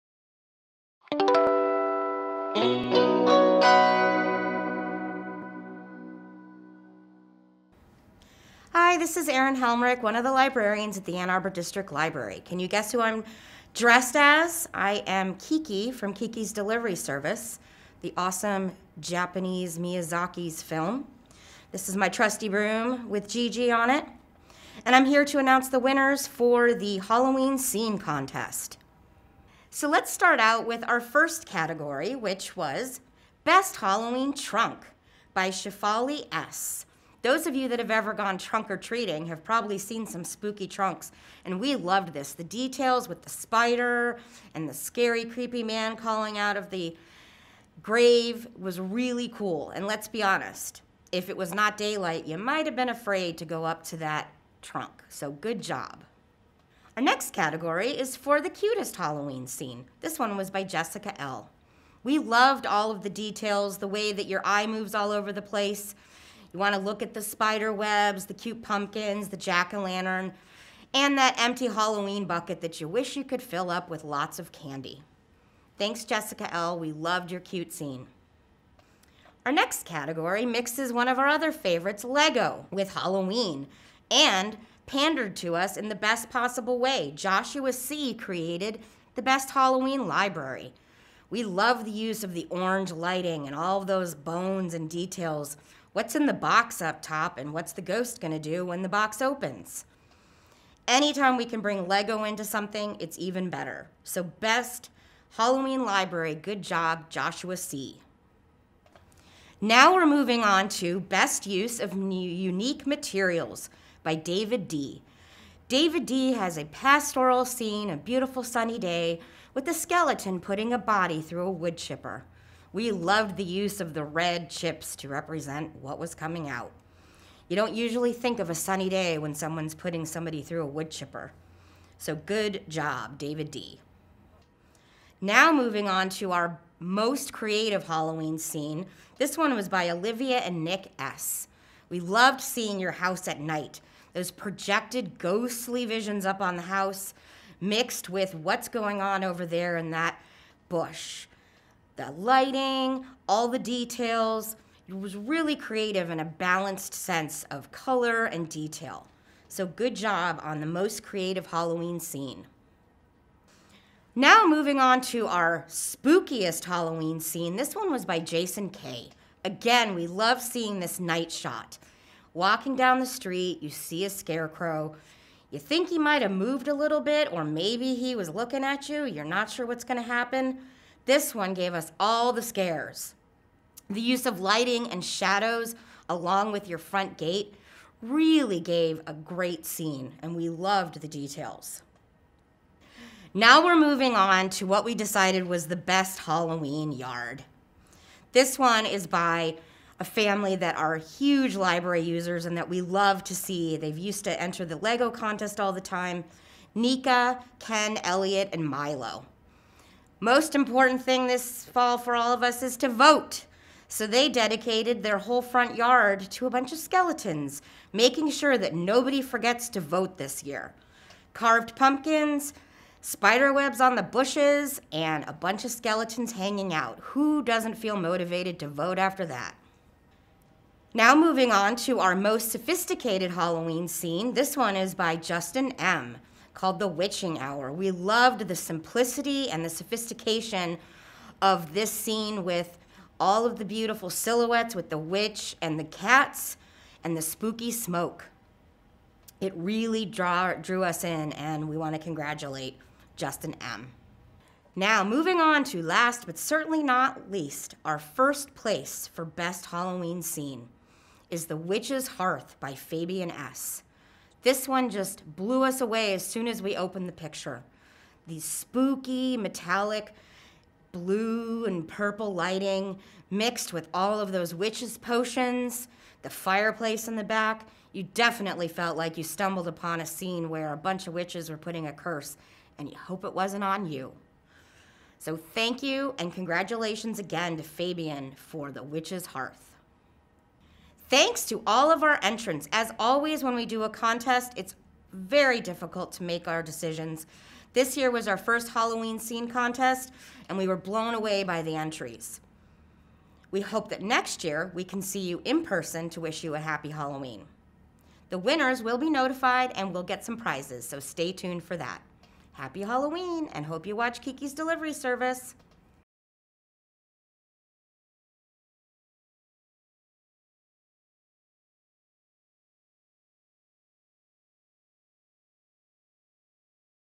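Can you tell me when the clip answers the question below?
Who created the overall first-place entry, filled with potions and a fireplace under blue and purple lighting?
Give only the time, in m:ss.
4:22.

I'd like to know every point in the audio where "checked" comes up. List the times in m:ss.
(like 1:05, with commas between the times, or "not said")
not said.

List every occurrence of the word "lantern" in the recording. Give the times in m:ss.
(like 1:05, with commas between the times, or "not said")
1:09.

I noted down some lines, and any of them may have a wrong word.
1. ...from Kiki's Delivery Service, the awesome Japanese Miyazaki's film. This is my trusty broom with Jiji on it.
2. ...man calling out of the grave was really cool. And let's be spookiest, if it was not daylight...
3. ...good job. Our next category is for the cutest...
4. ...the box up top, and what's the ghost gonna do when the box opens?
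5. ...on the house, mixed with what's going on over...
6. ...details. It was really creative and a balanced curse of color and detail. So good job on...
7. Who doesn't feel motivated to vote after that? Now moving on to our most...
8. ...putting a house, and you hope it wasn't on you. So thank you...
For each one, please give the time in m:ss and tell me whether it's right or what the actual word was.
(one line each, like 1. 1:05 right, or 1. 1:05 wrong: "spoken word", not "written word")
1. 0:15 right
2. 0:45 wrong: "honest", not "spookiest"
3. 0:55 right
4. 1:36 right
5. 2:26 right
6. 2:33 wrong: "sense", not "curse"
7. 3:47 right
8. 4:41 wrong: "curse", not "house".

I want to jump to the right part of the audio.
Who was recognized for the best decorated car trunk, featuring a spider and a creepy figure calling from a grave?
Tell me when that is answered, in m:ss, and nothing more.
0:35.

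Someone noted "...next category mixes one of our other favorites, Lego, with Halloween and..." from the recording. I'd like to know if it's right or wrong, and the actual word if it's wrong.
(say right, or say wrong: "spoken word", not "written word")
right.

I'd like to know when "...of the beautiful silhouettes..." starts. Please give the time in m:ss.
4:03.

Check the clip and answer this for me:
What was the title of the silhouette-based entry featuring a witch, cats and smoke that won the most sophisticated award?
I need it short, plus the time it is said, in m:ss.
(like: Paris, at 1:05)
The Witching Hour, at 3:56.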